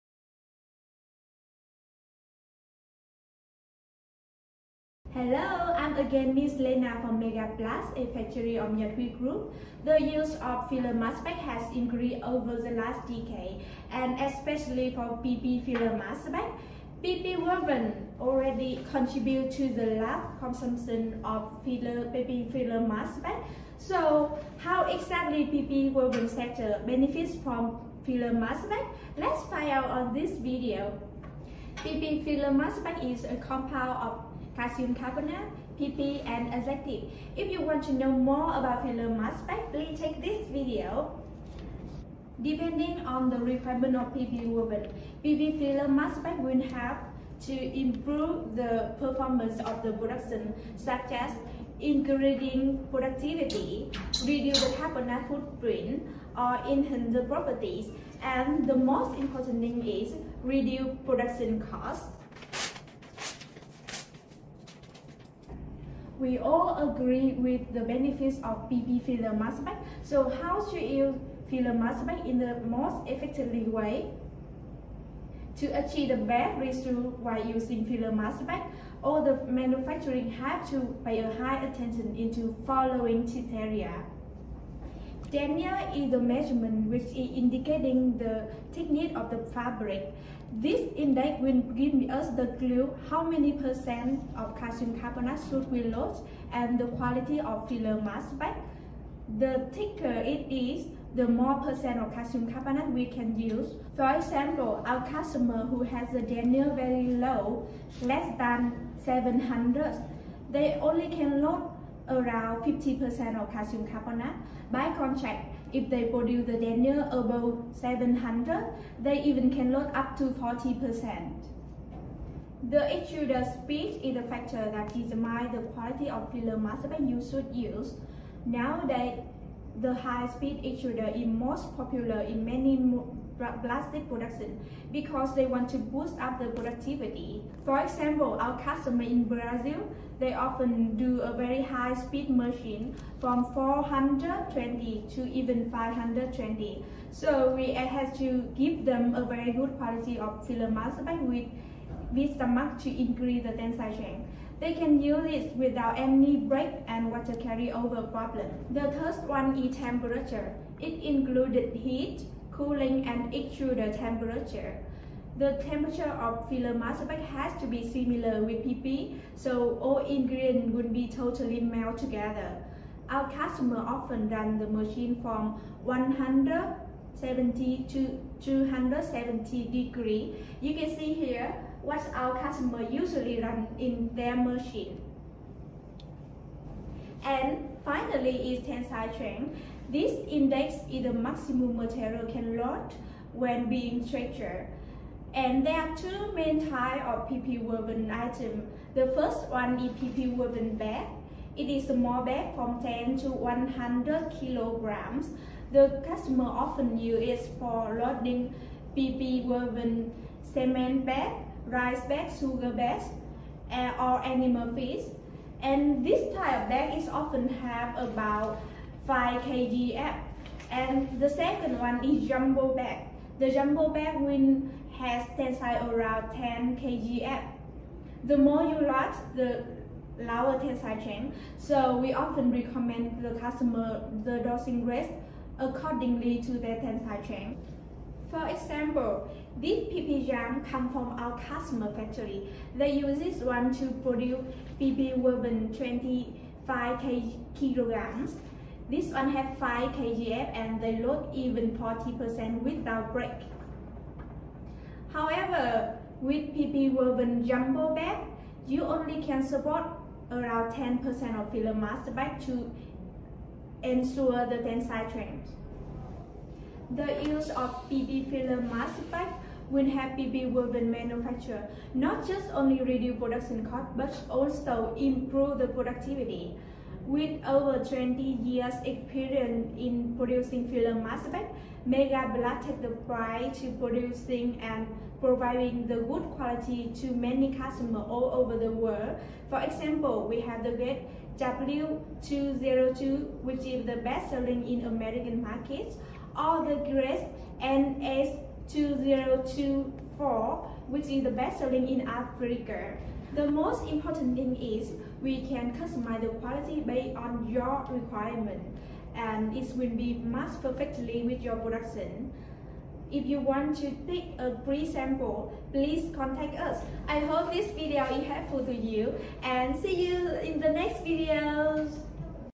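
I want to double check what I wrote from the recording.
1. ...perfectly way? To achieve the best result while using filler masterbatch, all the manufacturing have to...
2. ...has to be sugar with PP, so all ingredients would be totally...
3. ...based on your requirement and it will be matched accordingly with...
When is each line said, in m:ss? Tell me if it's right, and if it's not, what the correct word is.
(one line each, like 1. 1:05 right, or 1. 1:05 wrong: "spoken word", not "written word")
1. 1:13 wrong: "effectively", not "perfectly"
2. 2:47 wrong: "similar", not "sugar"
3. 5:06 wrong: "perfectly", not "accordingly".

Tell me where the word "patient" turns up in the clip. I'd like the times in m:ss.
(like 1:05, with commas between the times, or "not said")
not said.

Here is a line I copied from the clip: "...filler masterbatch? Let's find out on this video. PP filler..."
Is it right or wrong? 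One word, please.
right.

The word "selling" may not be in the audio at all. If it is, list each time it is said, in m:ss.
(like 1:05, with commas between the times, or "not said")
4:54, 5:01.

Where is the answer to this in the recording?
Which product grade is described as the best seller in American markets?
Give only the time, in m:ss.
4:51.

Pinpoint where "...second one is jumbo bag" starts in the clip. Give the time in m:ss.
3:41.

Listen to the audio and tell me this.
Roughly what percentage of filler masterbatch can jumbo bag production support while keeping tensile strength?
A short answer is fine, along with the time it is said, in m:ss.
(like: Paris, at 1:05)
10%, at 4:20.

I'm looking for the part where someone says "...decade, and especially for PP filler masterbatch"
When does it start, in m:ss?
0:13.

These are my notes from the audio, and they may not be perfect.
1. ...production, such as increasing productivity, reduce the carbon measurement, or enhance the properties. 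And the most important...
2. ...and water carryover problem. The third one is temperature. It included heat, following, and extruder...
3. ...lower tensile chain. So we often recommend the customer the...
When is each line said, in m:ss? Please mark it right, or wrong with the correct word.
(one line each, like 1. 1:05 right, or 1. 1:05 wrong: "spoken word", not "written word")
1. 0:49 wrong: "footprint", not "measurement"
2. 2:36 wrong: "cooling", not "following"
3. 3:50 right.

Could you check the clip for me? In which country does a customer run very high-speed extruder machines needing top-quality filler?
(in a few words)
Brazil.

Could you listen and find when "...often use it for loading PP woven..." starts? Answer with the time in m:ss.
3:26.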